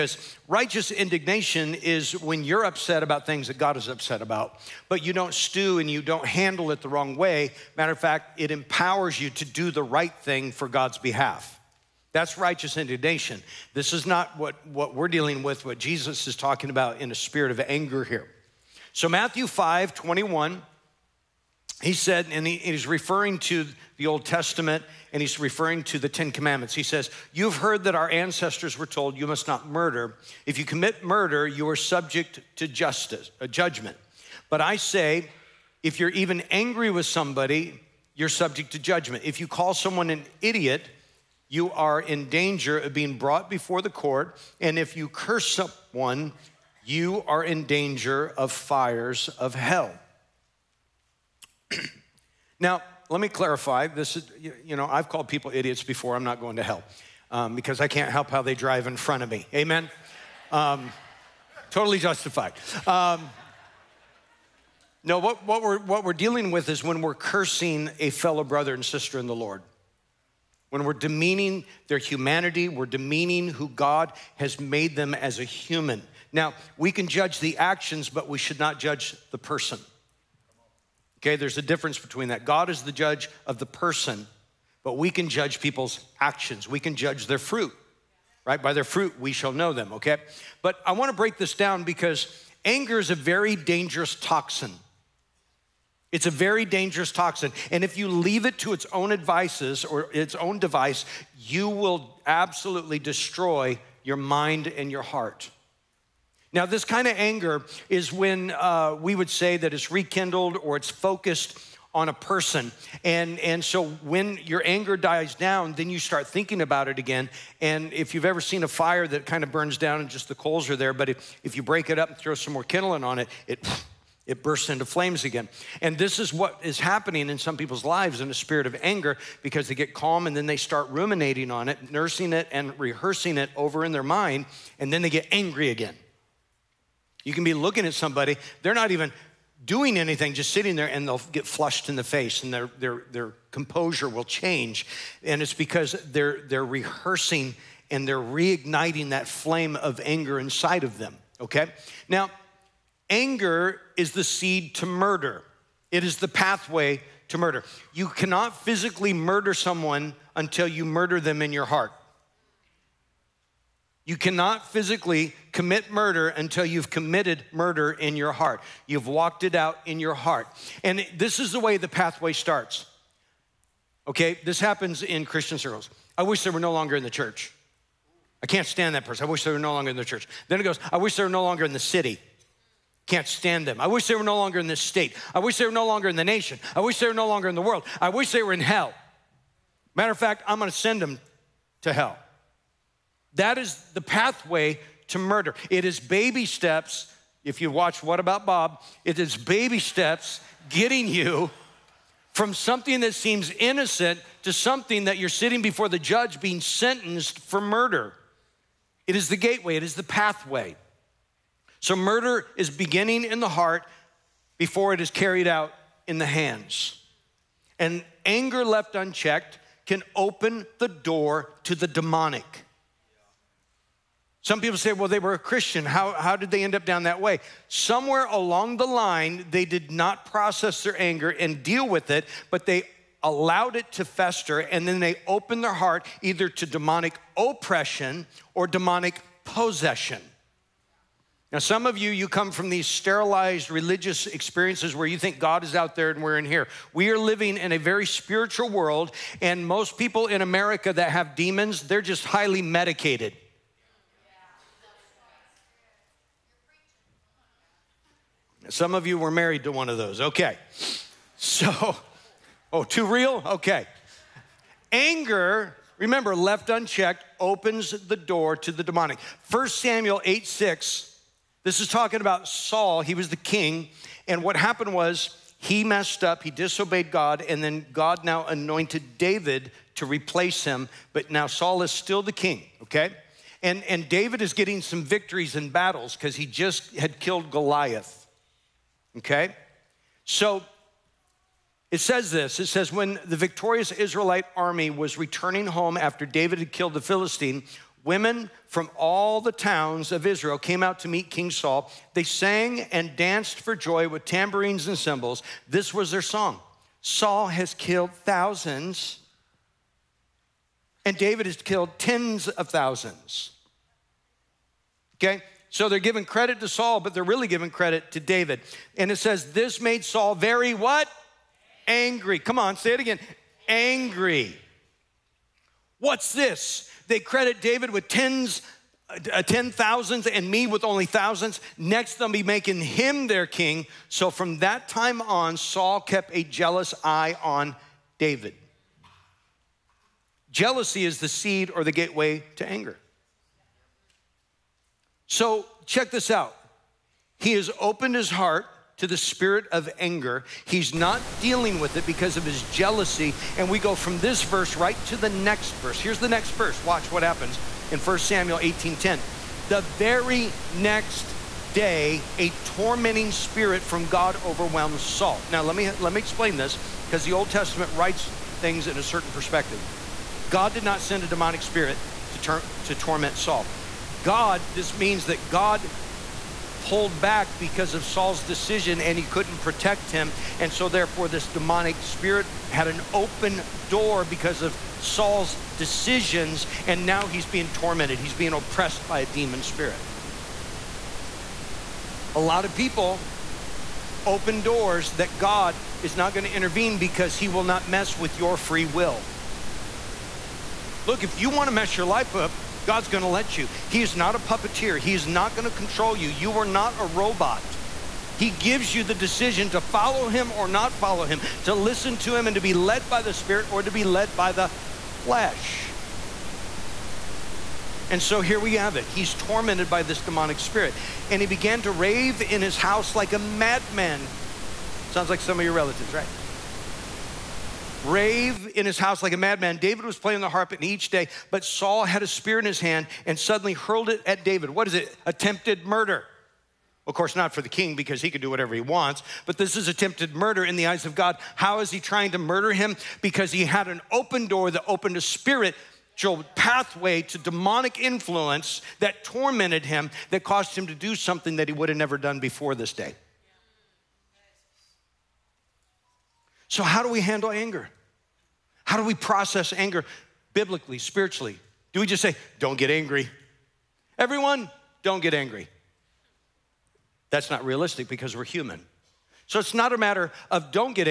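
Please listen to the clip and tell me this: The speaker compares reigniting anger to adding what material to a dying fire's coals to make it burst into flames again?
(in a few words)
kindling.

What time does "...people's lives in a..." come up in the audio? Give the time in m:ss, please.
2:07.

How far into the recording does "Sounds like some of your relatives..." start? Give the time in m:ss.
7:05.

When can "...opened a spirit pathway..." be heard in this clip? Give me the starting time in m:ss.
7:24.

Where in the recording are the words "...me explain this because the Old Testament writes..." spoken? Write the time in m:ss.
6:06.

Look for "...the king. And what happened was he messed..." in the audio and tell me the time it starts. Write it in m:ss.
4:33.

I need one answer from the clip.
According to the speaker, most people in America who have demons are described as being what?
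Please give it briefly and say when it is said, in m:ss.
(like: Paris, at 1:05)
highly medicated, at 4:12.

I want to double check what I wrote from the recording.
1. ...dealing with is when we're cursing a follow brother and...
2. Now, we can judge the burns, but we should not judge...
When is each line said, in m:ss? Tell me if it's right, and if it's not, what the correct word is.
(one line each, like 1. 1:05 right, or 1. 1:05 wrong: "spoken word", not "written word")
1. 1:06 wrong: "fellow", not "follow"
2. 1:16 wrong: "actions", not "burns".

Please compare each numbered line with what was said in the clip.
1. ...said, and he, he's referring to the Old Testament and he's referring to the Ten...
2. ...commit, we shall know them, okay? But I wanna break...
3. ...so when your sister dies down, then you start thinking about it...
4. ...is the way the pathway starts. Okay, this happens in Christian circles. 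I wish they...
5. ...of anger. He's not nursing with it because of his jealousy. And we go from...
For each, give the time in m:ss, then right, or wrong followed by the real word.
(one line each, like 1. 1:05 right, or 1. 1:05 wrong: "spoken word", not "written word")
1. 0:21 right
2. 1:28 wrong: "fruit", not "commit"
3. 1:53 wrong: "anger", not "sister"
4. 2:51 right
5. 5:49 wrong: "dealing", not "nursing".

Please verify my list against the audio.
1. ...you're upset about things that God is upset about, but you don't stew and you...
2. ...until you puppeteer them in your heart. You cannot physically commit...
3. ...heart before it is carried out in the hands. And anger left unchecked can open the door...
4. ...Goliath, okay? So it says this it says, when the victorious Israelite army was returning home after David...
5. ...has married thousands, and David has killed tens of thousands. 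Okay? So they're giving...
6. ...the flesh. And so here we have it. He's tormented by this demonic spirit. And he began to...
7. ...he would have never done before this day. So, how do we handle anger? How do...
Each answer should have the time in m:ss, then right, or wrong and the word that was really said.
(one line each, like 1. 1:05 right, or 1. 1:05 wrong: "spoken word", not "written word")
1. 0:02 right
2. 2:40 wrong: "murder", not "puppeteer"
3. 3:33 right
4. 4:47 right
5. 5:07 wrong: "killed", not "married"
6. 6:54 right
7. 7:31 right.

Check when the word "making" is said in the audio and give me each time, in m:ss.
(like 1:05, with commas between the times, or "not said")
5:32.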